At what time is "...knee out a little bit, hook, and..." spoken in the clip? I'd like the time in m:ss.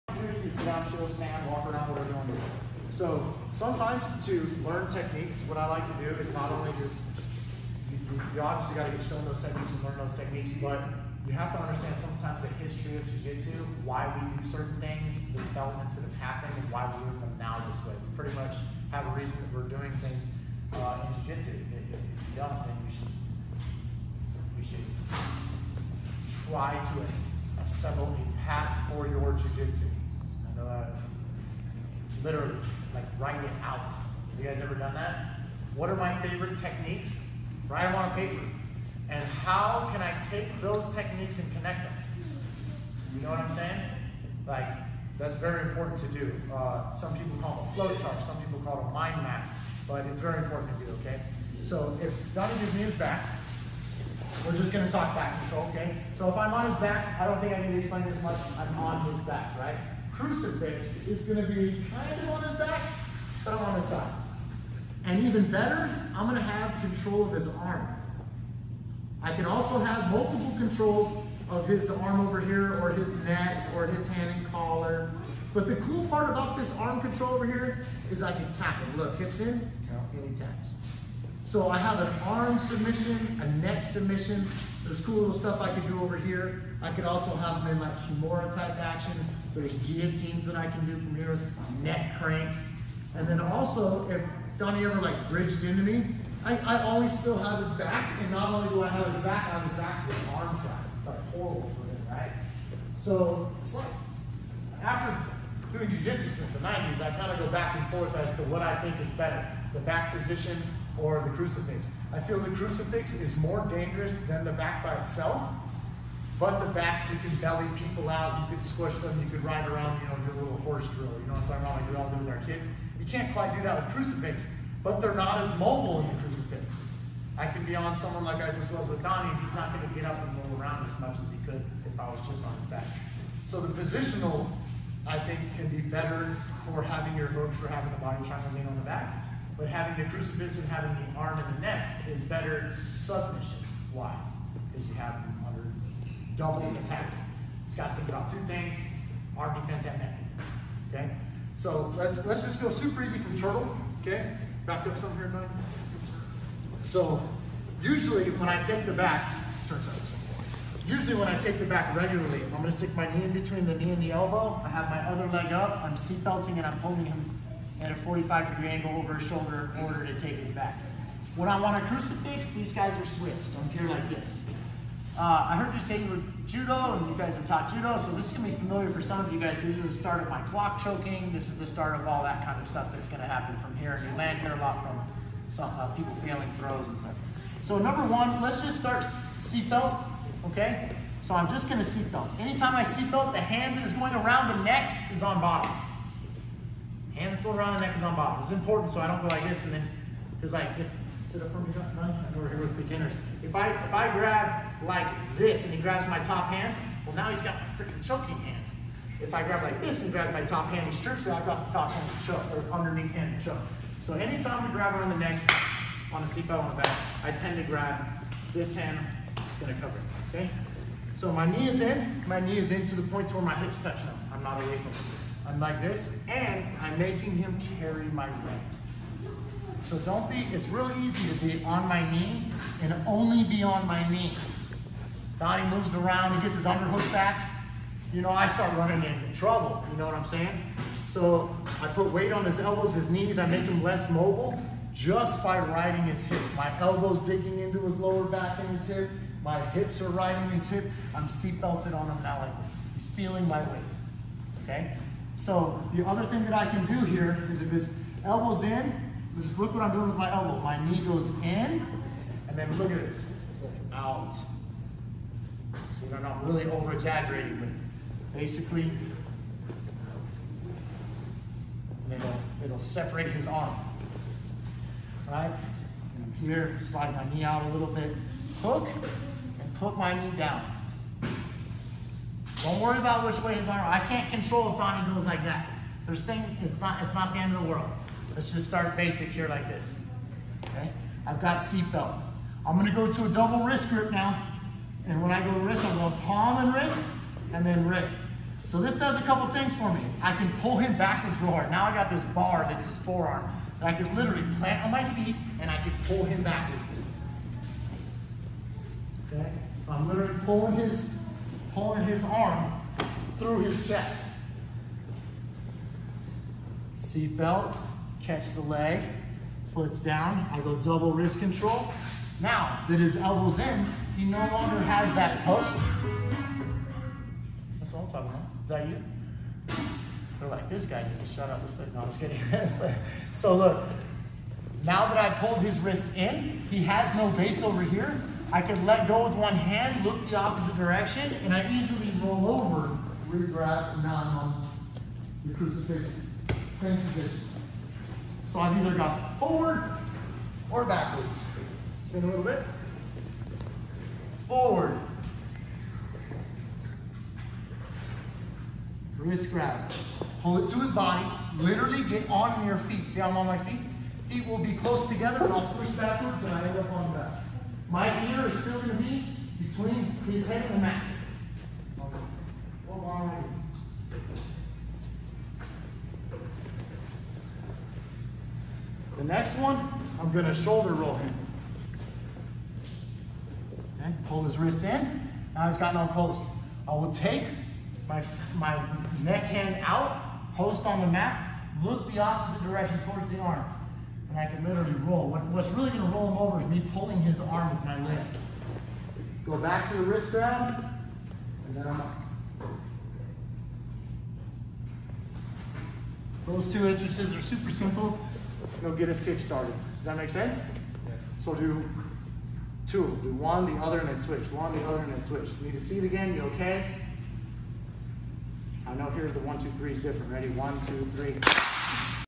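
4:37.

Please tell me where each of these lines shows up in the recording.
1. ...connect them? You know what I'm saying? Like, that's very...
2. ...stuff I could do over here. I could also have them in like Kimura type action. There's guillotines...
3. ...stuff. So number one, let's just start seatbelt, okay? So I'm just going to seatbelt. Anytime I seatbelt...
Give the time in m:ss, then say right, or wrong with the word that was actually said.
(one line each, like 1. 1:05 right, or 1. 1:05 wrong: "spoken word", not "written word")
1. 0:41 right
2. 1:25 right
3. 3:06 right.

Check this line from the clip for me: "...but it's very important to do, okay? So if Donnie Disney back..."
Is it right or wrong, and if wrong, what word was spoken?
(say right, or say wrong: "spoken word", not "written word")
right.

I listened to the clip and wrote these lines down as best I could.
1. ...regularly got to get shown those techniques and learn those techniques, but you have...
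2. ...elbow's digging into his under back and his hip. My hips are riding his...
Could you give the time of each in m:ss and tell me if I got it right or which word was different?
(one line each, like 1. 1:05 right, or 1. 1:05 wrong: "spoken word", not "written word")
1. 0:08 wrong: "obviously", not "regularly"
2. 4:06 wrong: "lower", not "under".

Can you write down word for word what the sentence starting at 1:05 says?
And even better, I'm going to have control of his arm.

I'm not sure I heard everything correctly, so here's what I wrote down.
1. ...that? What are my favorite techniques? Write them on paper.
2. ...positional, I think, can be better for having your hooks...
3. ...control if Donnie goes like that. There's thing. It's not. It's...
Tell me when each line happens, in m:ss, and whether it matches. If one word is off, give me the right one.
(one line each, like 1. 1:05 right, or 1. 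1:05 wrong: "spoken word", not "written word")
1. 0:34 right
2. 2:13 right
3. 4:44 right.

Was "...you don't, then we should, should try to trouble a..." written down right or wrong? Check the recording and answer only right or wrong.
wrong.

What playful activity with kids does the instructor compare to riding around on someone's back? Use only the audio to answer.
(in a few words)
horse drill.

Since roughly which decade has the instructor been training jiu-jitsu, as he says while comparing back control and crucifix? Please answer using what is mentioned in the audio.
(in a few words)
the 90s.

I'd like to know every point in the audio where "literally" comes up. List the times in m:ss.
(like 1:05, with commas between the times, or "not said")
0:32, 5:04, 5:10, 6:01, 6:34.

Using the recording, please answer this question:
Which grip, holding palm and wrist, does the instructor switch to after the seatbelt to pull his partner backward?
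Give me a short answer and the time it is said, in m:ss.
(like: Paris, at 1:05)
double wrist grip, at 4:53.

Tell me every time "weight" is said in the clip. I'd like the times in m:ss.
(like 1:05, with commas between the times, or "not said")
3:48, 4:02, 4:13.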